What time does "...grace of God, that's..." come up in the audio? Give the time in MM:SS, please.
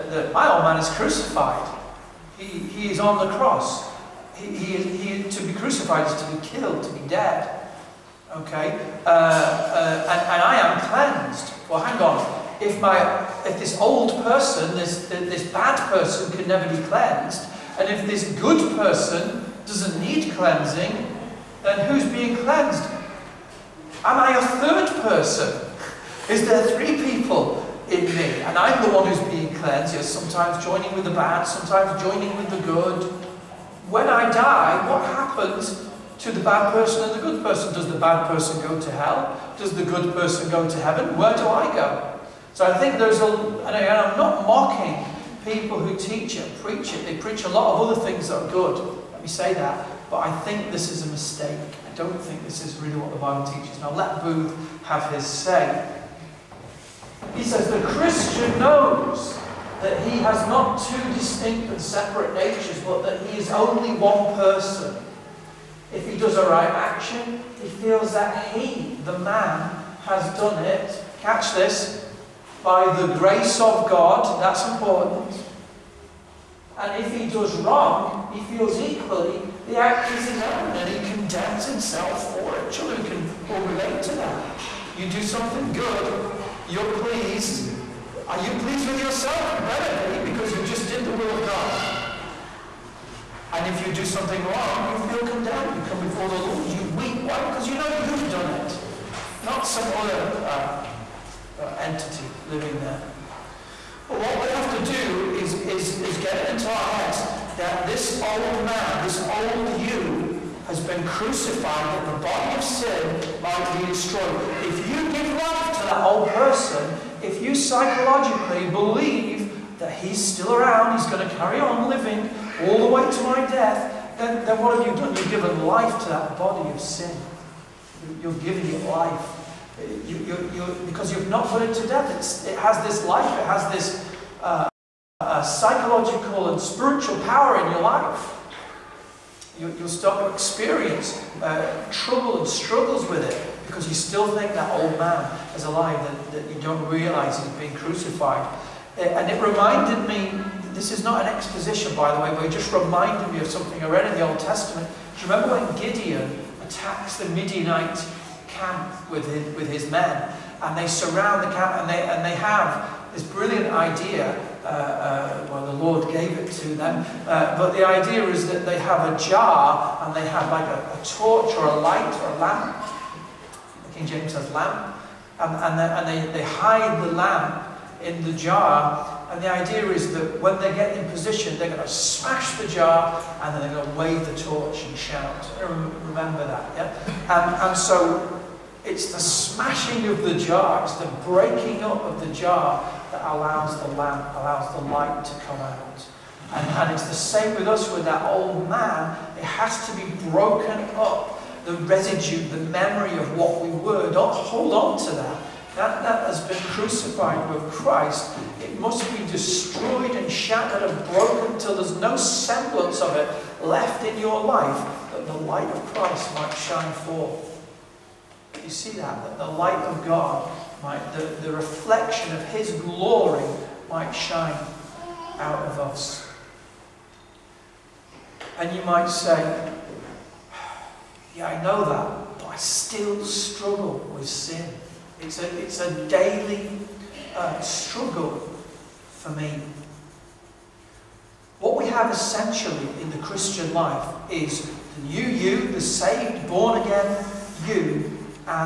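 01:13.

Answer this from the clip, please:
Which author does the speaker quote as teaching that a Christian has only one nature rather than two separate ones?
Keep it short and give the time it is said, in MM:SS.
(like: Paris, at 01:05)
Booth, at 00:54.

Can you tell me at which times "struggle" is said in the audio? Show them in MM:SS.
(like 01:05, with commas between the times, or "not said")
02:22, 03:53, 03:57.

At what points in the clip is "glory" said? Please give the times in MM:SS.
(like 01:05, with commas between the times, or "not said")
03:42.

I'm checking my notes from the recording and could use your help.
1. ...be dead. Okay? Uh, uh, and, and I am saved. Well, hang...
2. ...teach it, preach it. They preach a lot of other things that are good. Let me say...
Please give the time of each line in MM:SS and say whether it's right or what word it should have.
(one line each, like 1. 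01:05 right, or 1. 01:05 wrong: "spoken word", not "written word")
1. 00:06 wrong: "cleansed", not "saved"
2. 00:45 right.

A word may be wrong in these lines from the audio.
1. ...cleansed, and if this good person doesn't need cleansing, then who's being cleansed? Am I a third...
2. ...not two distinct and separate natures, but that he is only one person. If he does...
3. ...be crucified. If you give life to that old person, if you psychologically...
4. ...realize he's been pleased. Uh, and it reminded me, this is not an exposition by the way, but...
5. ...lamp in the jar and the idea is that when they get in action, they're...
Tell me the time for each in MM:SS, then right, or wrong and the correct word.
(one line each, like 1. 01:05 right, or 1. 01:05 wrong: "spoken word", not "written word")
1. 00:16 right
2. 01:00 right
3. 01:53 wrong: "destroyed", not "crucified"
4. 02:26 wrong: "crucified", not "pleased"
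5. 02:57 wrong: "position", not "action".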